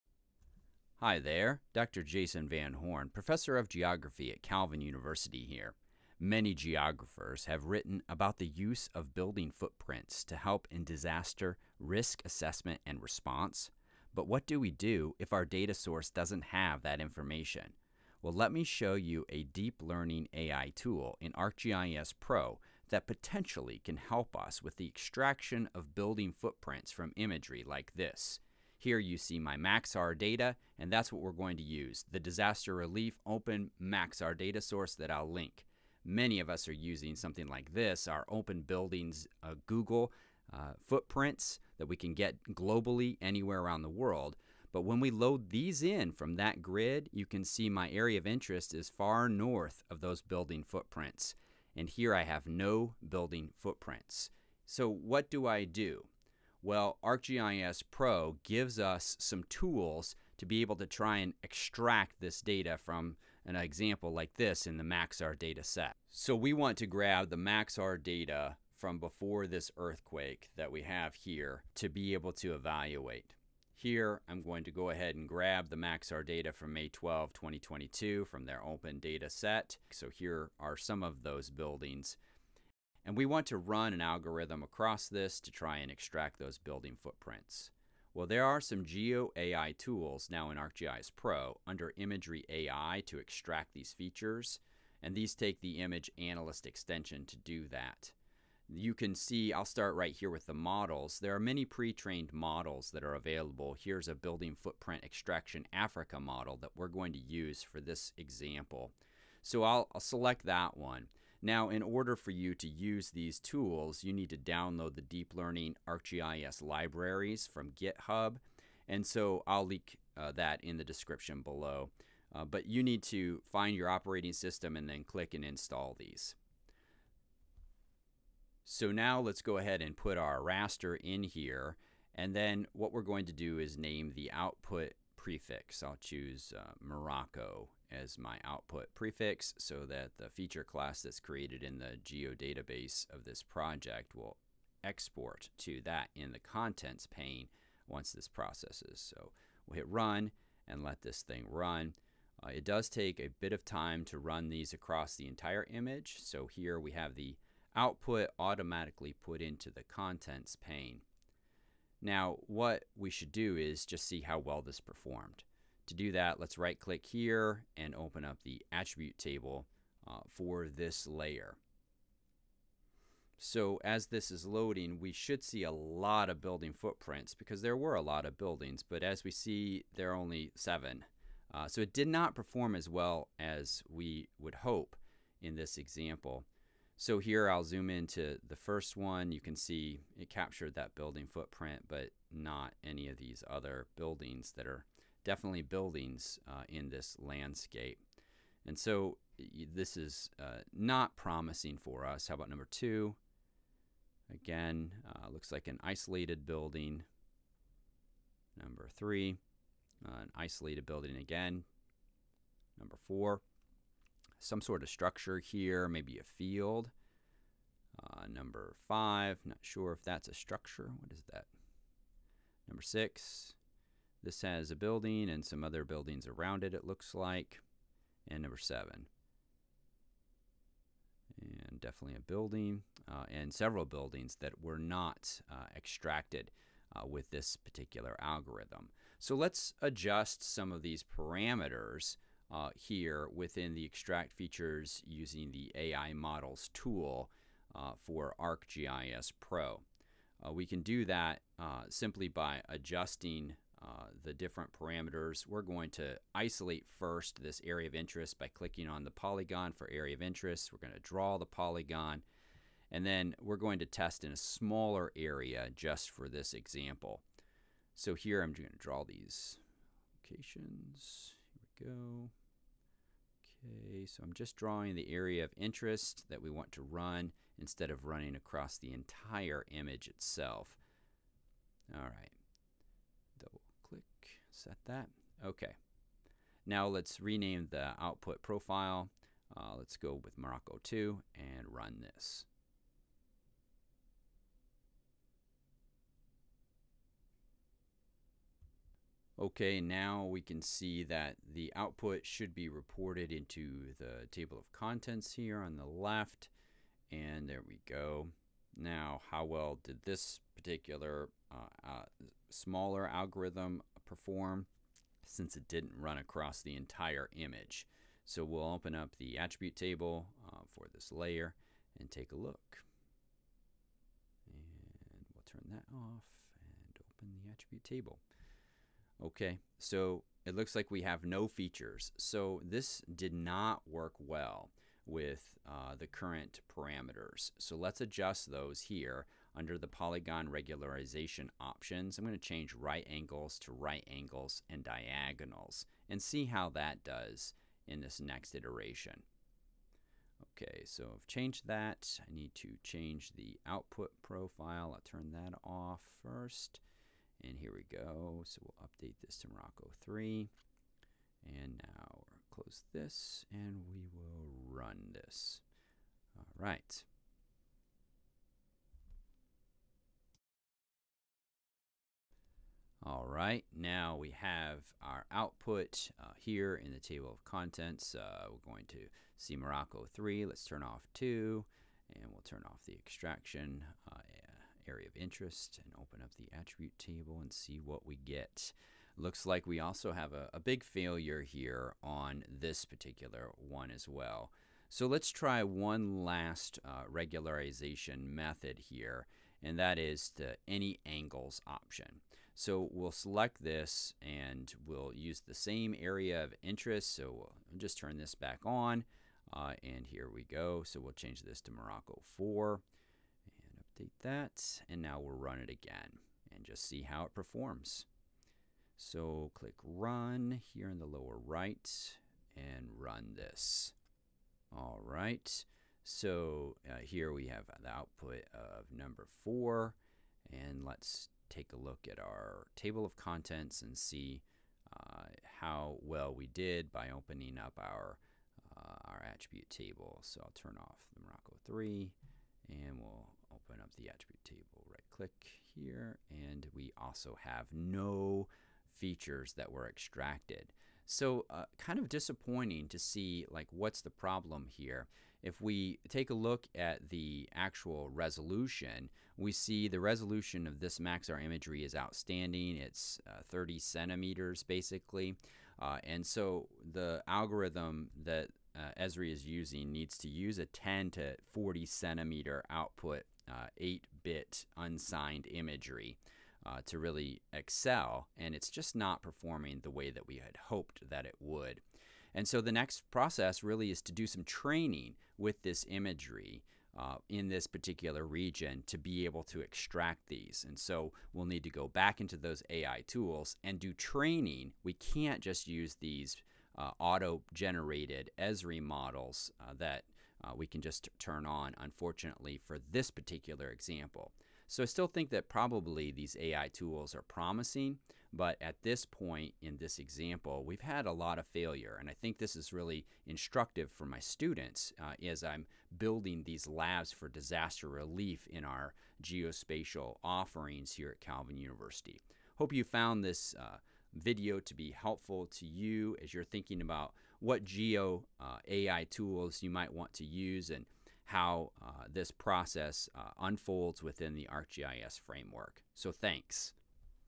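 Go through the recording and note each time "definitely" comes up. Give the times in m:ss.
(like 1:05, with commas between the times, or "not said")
3:15, 3:51.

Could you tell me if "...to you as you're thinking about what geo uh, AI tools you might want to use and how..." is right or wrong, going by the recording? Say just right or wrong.
right.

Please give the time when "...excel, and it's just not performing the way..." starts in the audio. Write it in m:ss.
7:57.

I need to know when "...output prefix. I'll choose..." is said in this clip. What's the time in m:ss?
2:14.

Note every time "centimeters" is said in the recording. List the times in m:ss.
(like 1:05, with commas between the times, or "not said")
7:43, 7:51.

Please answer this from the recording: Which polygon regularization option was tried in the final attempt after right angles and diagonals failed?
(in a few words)
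Any angles.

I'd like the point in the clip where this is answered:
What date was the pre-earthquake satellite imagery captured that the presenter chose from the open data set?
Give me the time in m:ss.
1:16.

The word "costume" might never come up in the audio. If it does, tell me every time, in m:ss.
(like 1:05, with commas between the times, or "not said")
not said.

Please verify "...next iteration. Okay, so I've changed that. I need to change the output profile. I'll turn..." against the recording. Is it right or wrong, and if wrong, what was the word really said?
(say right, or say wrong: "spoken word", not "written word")
right.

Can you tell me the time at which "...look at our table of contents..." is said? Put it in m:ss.
7:11.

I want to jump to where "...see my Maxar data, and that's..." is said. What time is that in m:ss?
0:29.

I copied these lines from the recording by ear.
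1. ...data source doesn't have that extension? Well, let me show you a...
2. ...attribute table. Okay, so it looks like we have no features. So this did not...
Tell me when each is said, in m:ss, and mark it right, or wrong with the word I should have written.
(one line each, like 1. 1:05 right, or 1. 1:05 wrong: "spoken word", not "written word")
1. 0:15 wrong: "information", not "extension"
2. 5:27 right.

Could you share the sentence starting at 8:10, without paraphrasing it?
And so we'll need to go back into those AI tools and do training.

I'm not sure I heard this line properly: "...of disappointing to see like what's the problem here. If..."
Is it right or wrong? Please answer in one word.
right.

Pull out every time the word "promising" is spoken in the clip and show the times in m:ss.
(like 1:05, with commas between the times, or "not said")
3:21, 8:27.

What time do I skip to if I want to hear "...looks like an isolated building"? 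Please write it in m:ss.
3:25.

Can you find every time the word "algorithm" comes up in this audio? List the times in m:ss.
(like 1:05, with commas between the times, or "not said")
1:24, 3:58, 5:13, 7:47.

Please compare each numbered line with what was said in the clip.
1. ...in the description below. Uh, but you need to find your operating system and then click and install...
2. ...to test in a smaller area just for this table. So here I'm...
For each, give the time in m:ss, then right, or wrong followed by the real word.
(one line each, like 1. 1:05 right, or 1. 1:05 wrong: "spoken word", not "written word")
1. 2:00 right
2. 4:23 wrong: "example", not "table".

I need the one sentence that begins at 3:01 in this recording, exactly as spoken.
Uh, so it did not perform as well as we would hope in this example.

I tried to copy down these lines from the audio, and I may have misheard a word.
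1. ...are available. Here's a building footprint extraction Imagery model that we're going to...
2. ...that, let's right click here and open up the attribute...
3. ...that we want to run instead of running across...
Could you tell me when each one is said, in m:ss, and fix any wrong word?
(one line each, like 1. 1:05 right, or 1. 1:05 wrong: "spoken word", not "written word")
1. 1:43 wrong: "Africa", not "Imagery"
2. 2:46 right
3. 4:36 right.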